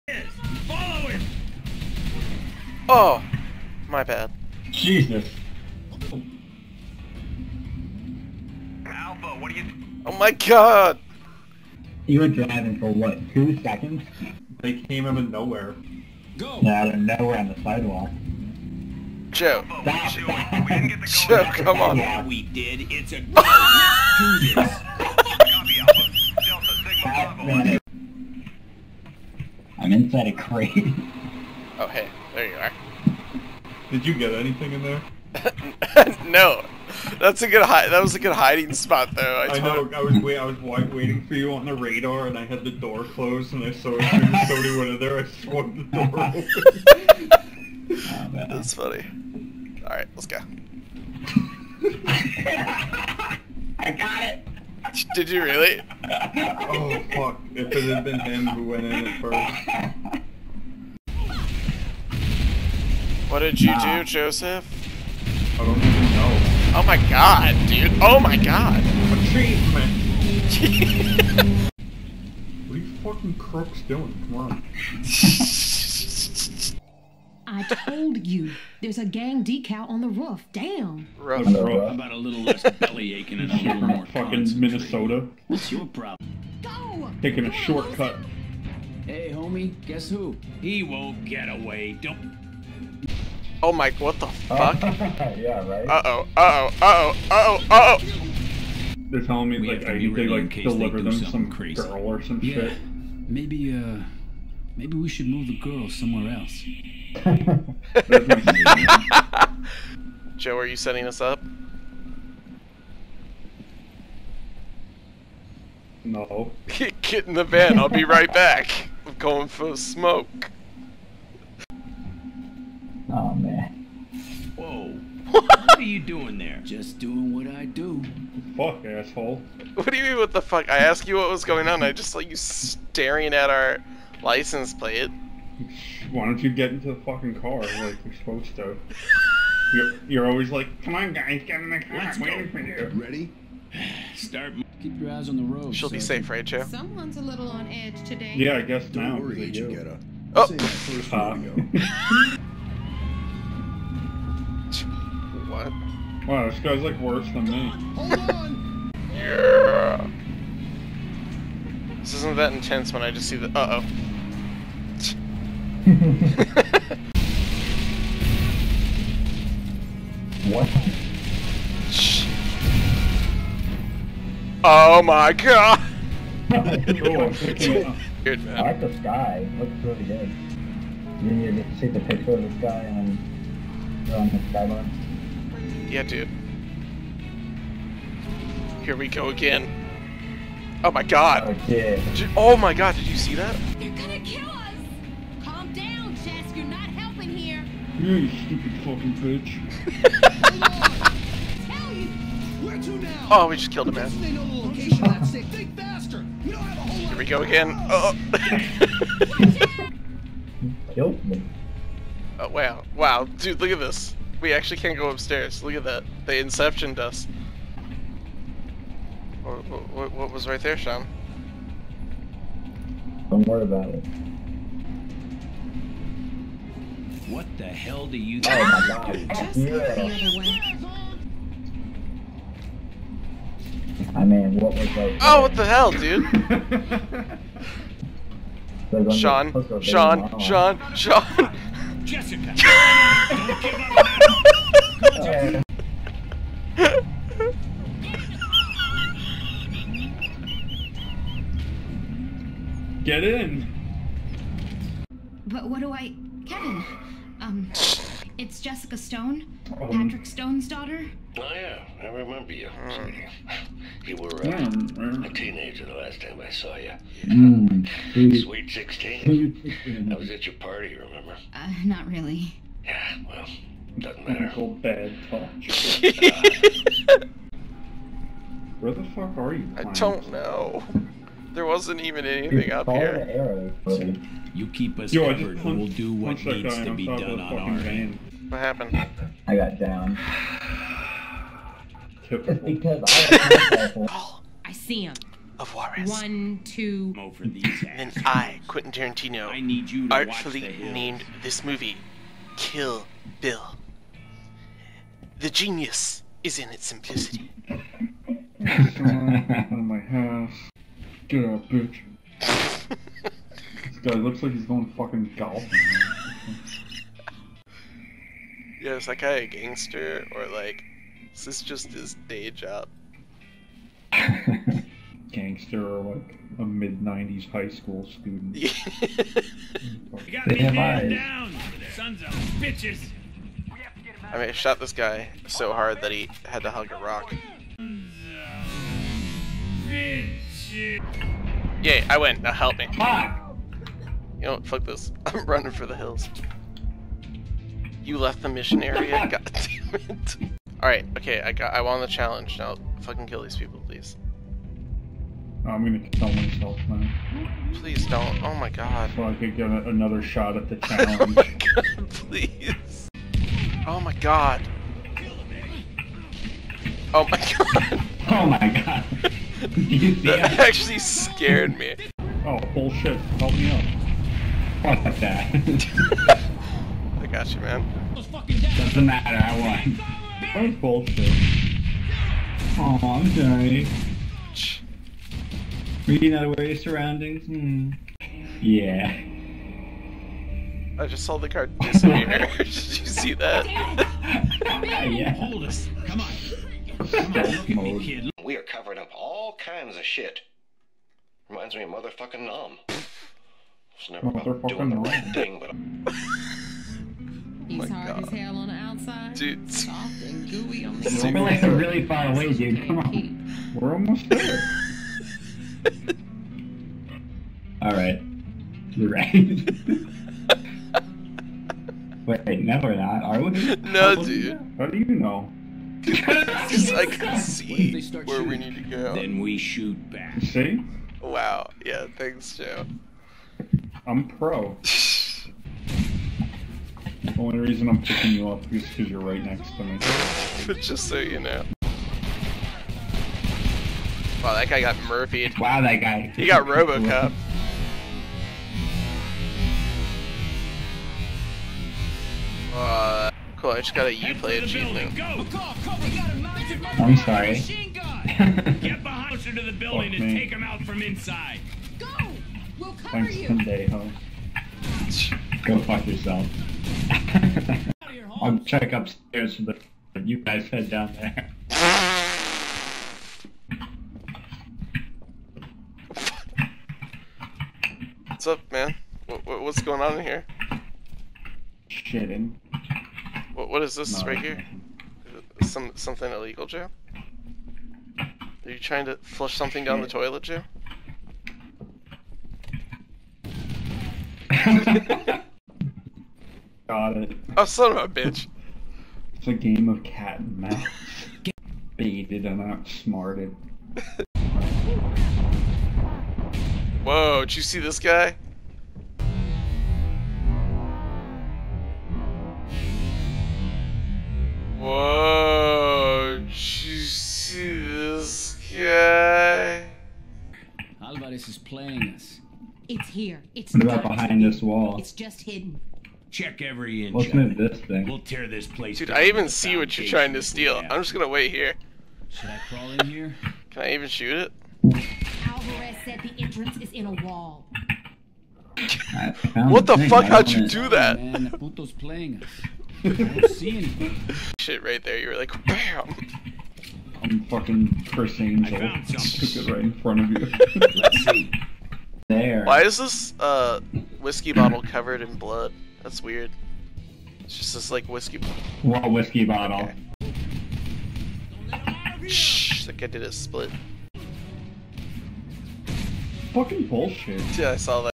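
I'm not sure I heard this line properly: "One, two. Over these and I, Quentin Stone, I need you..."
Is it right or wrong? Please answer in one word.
wrong.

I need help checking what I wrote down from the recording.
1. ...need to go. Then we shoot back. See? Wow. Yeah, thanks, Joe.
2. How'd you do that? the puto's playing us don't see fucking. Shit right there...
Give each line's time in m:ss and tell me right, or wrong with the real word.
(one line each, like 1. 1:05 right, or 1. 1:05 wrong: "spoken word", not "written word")
1. 7:08 right
2. 9:00 wrong: "anything", not "fucking".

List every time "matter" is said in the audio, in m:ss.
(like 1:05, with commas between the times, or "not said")
4:34, 6:19.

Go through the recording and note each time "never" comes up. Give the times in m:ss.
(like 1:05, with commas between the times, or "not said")
6:44, 7:02.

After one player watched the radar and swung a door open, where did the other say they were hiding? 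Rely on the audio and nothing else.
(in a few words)
Inside a crate.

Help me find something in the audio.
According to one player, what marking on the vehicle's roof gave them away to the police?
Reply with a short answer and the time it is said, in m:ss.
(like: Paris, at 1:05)
A gang decal, at 1:19.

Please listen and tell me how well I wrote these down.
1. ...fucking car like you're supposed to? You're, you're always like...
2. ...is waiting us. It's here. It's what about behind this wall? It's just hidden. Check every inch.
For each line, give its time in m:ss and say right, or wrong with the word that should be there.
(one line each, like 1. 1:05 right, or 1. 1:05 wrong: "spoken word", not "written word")
1. 2:17 right
2. 8:41 wrong: "playing", not "waiting".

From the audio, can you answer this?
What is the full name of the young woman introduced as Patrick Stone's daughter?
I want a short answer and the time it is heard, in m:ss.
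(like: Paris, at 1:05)
Jessica Stone, at 4:18.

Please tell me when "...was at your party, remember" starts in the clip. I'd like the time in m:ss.
4:30.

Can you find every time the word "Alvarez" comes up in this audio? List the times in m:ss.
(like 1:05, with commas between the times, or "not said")
8:40, 8:55.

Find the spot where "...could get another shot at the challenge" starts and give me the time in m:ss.
5:59.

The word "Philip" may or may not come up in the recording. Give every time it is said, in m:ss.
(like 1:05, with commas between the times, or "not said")
not said.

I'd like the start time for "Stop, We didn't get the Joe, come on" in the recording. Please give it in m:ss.
0:19.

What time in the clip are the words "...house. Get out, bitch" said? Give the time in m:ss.
5:09.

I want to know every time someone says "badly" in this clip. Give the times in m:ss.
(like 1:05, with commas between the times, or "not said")
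not said.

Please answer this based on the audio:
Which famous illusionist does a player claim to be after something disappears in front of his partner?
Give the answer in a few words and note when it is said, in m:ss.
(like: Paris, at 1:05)
Criss Angel, at 9:08.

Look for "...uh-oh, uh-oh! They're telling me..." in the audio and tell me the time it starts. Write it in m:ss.
1:37.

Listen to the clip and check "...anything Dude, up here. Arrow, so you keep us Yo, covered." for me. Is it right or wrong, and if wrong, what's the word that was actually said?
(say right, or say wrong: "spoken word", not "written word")
right.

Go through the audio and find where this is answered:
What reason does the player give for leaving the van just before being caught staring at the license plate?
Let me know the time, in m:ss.
1:59.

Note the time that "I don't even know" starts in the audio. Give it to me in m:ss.
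1:05.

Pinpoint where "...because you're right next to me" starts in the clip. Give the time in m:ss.
7:18.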